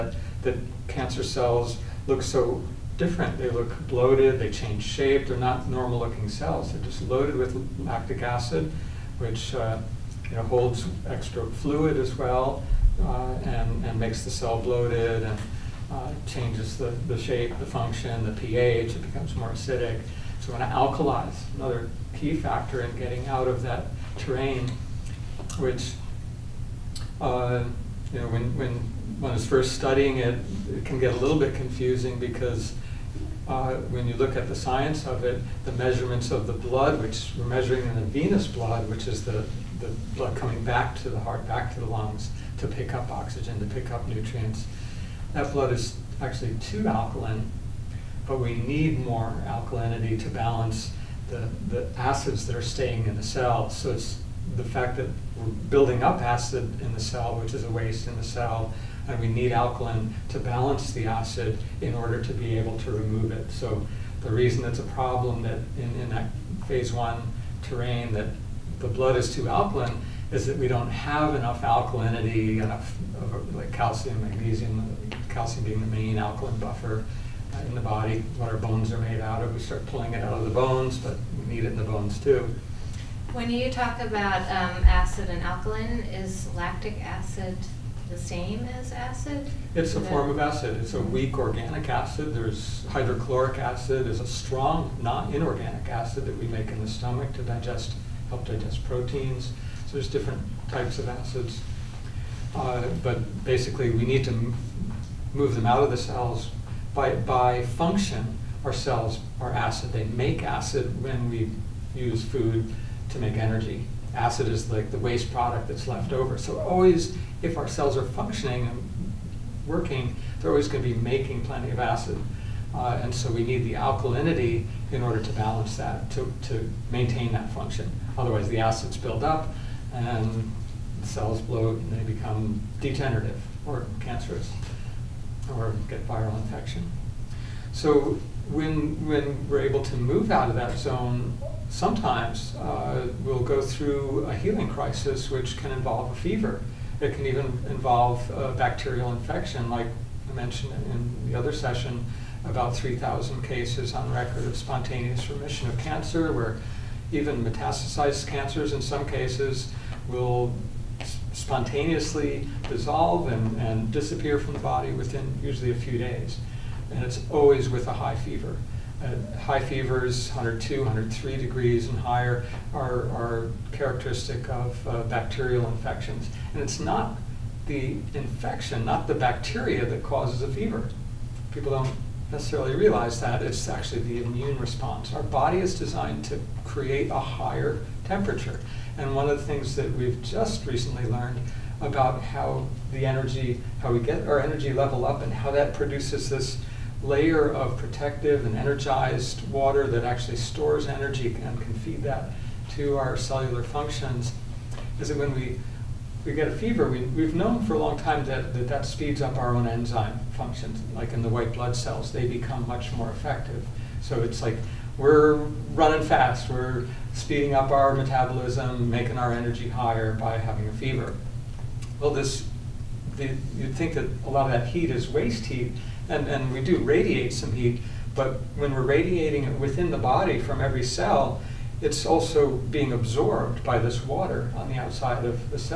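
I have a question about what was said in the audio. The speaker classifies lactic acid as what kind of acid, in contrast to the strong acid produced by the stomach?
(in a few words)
weak organic acid.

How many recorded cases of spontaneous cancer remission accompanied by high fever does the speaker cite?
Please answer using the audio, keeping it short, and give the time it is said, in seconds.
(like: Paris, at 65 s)
3,000, at 152 s.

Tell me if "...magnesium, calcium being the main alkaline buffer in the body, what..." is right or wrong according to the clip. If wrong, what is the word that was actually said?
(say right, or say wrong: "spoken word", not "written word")
right.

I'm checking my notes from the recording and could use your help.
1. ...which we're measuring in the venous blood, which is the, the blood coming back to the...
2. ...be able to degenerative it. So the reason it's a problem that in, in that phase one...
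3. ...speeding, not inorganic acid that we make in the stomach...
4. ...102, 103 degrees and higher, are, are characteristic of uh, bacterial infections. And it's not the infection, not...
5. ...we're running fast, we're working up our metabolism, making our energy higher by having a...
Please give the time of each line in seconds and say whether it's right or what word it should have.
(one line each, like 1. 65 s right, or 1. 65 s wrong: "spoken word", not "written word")
1. 37 s right
2. 62 s wrong: "remove", not "degenerative"
3. 94 s wrong: "strong", not "speeding"
4. 170 s right
5. 214 s wrong: "speeding", not "working".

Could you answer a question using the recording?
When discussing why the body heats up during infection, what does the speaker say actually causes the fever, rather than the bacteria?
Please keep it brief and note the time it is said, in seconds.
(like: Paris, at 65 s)
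the immune response, at 184 s.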